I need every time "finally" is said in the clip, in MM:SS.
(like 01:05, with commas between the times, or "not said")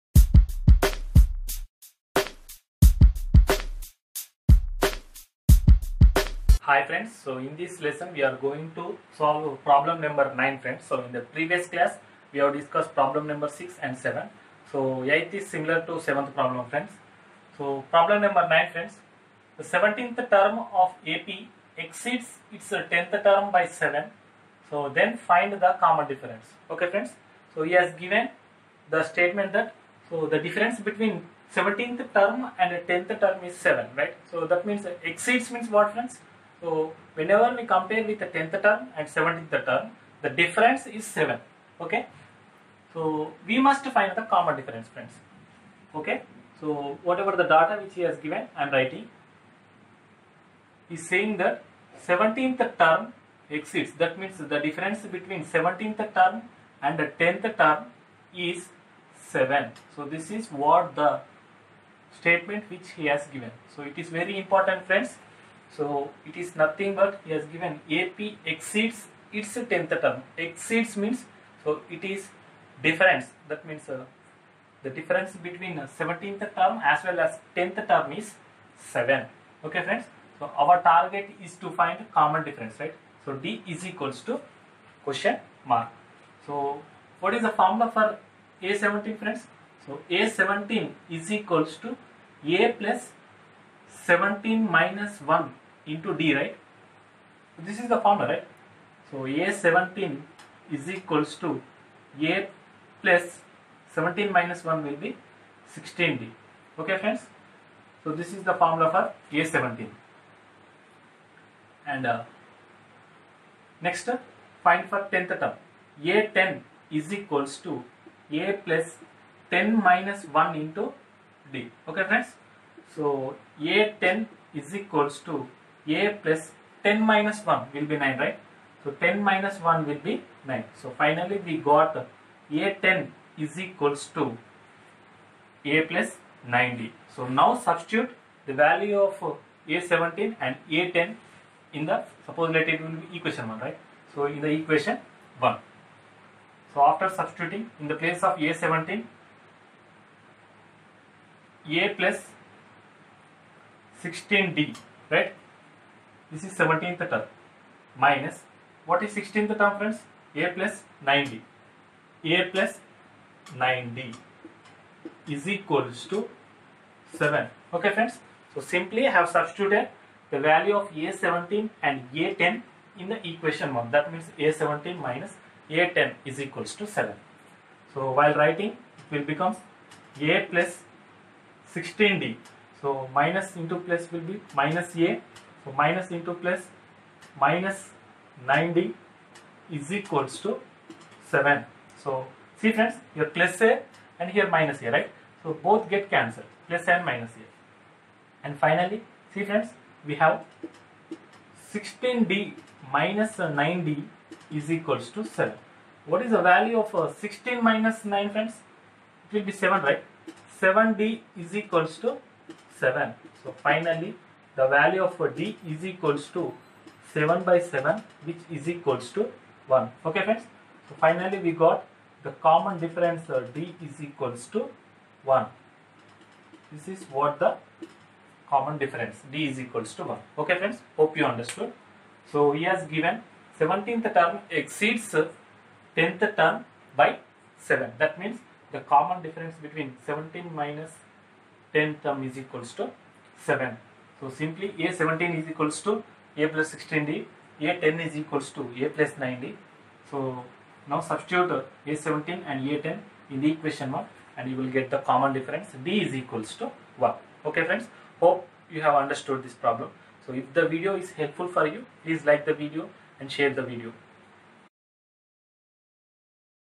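02:10, 03:18, 03:33, 03:41.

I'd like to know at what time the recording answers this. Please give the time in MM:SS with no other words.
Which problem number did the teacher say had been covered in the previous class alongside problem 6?
00:13.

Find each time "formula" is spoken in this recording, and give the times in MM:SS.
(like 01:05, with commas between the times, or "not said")
01:27, 01:37, 01:48.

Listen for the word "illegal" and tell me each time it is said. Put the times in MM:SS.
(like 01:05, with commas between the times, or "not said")
not said.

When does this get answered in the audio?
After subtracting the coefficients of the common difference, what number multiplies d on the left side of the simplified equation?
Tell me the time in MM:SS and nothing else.
03:30.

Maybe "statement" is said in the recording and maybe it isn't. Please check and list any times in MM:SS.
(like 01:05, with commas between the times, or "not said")
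00:29, 01:02.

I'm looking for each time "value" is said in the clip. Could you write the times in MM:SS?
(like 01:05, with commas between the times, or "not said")
02:18, 02:50, 03:26, 03:34.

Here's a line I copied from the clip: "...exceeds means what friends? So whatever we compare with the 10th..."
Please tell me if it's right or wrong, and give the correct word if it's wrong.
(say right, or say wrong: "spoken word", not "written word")
wrong: "whenever", not "whatever".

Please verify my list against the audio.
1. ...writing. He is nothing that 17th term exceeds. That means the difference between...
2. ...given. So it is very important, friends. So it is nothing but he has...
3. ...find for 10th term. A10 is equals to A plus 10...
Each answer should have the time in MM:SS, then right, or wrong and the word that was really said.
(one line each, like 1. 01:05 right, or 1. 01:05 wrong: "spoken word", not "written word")
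1. 00:48 wrong: "saying", not "nothing"
2. 01:03 right
3. 01:54 right.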